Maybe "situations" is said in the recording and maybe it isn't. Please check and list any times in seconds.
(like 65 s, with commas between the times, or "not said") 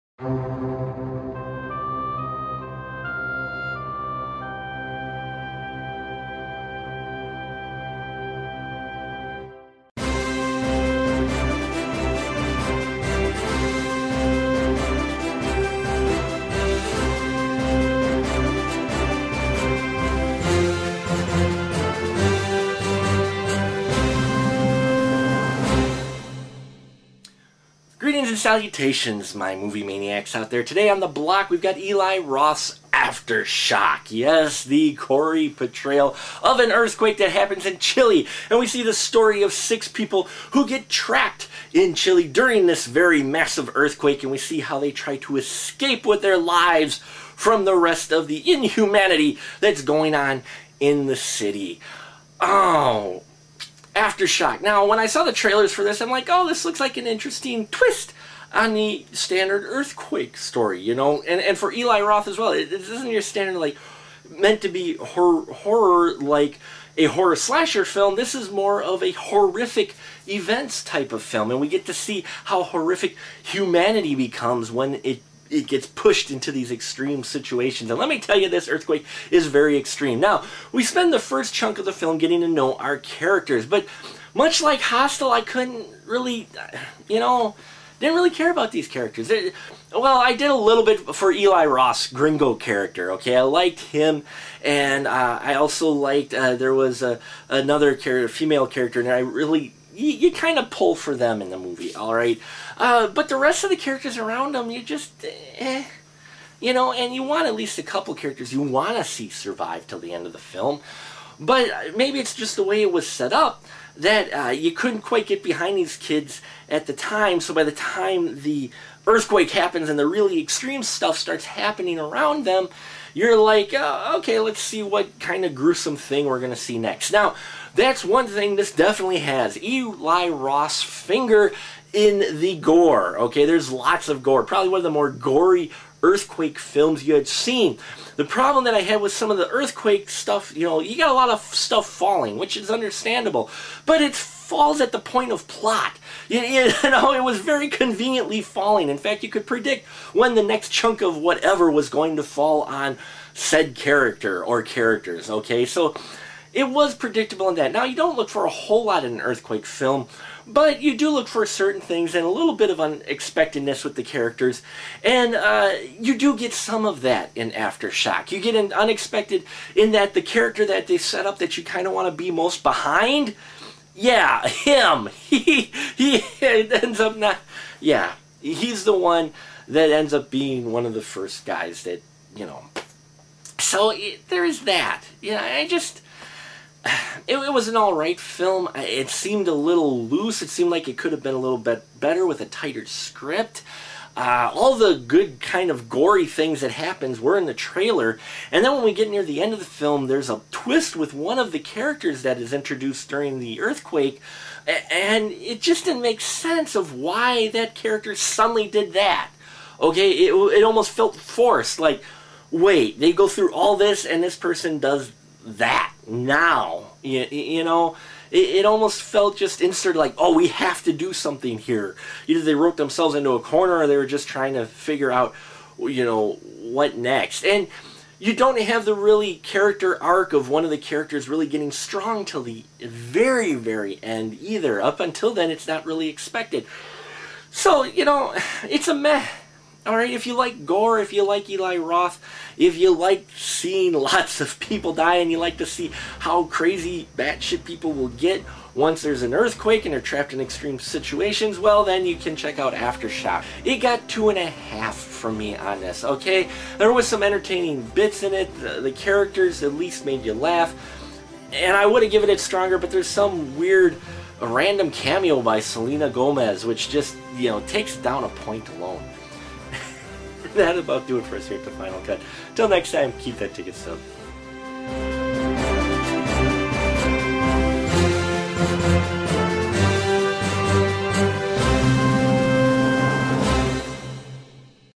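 77 s, 250 s.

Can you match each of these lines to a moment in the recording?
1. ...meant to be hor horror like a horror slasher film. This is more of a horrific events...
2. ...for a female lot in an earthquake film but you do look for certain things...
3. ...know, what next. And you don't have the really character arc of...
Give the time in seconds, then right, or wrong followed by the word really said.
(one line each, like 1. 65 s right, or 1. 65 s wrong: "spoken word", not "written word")
1. 64 s right
2. 158 s wrong: "whole", not "female"
3. 226 s right.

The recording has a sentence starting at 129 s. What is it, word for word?
Eli Roth's finger in the gore.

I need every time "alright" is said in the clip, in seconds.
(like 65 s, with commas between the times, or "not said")
187 s, 239 s.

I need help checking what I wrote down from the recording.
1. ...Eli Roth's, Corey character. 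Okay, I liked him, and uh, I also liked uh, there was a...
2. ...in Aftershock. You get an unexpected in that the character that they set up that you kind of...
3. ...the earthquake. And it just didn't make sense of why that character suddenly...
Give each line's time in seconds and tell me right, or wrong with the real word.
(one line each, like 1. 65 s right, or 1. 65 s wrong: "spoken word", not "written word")
1. 91 s wrong: "Gringo", not "Corey"
2. 167 s right
3. 203 s right.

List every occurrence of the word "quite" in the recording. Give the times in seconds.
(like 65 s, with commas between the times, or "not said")
115 s.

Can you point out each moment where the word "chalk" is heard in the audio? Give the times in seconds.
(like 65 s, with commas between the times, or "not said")
not said.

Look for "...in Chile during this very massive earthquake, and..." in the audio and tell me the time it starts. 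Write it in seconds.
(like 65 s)
41 s.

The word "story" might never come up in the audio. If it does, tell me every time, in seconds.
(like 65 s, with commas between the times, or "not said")
38 s, 60 s.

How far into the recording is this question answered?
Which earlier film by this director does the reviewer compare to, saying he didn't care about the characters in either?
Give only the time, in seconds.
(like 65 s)
84 s.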